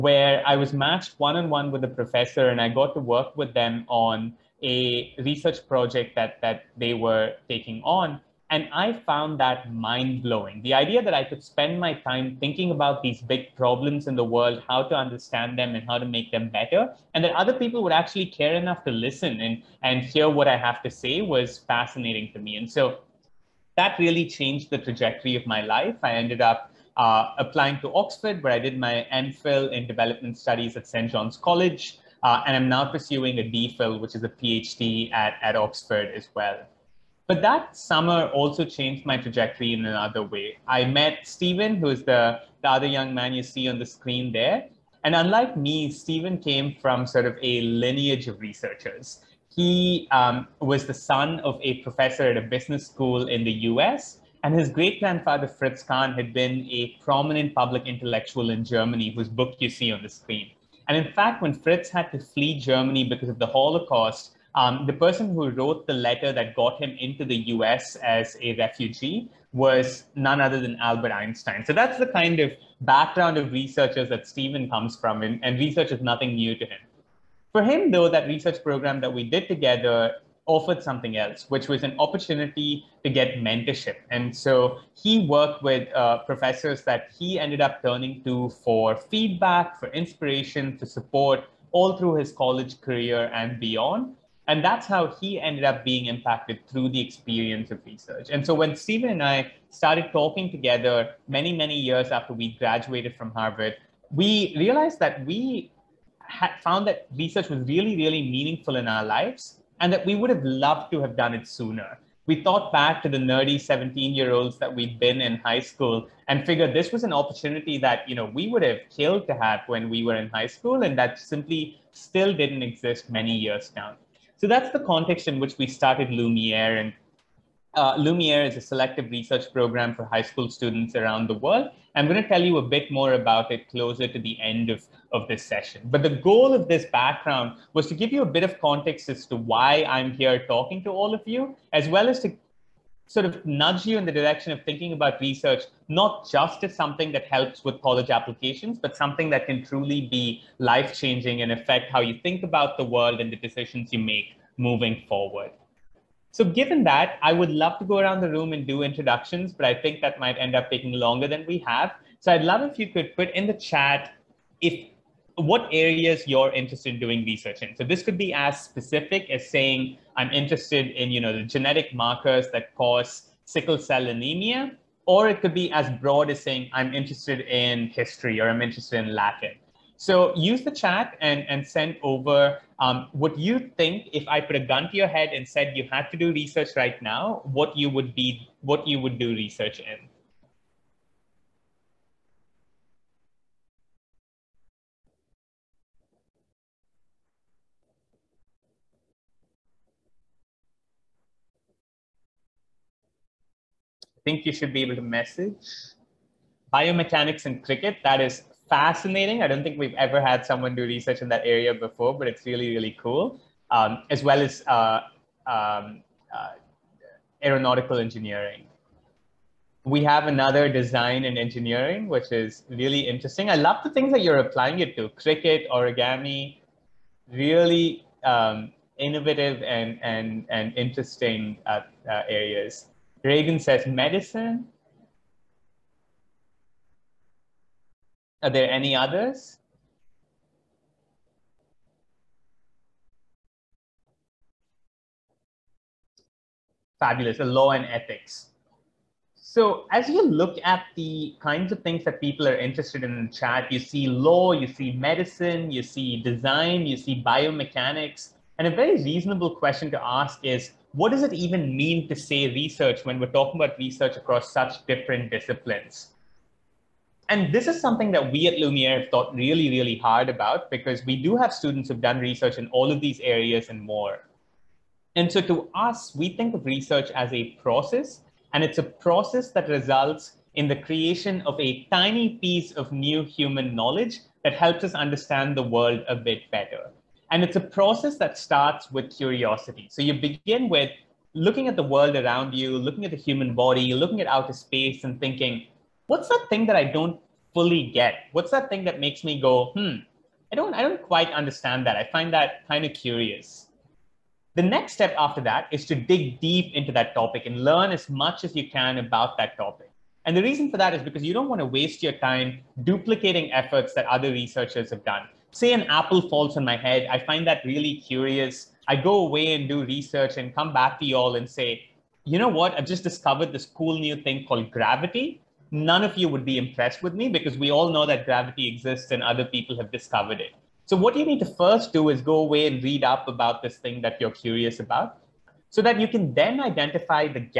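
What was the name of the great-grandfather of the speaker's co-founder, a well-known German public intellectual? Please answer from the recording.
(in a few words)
Fritz Kahn.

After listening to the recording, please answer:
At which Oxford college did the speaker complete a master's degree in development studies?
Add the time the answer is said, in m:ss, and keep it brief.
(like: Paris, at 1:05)
St. John's College, at 0:30.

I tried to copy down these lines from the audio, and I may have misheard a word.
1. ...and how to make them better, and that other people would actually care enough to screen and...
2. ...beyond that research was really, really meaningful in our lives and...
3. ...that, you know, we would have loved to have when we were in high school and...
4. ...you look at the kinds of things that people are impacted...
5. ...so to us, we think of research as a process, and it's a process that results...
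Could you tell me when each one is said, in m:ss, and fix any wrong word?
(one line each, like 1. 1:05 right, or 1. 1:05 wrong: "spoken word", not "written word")
1. 0:15 wrong: "listen", not "screen"
2. 1:46 wrong: "found", not "beyond"
3. 1:57 wrong: "killed", not "loved"
4. 4:10 wrong: "interested", not "impacted"
5. 4:35 right.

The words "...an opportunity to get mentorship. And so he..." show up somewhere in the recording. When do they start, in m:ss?
1:21.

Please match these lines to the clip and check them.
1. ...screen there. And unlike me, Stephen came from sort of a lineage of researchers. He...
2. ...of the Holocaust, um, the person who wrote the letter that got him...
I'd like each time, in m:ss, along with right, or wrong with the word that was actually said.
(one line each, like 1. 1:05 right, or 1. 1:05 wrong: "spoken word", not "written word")
1. 0:43 right
2. 1:03 right.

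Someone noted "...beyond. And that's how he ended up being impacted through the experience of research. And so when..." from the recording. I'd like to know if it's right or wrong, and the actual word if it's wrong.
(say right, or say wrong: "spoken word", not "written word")
right.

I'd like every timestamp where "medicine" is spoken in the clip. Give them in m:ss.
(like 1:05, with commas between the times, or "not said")
3:53, 4:14.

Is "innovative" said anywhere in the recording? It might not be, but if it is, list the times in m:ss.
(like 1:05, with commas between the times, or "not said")
3:49.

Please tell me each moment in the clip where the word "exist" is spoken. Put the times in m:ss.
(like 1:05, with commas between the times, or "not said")
2:02, 5:28.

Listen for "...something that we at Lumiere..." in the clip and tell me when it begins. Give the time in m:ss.
4:27.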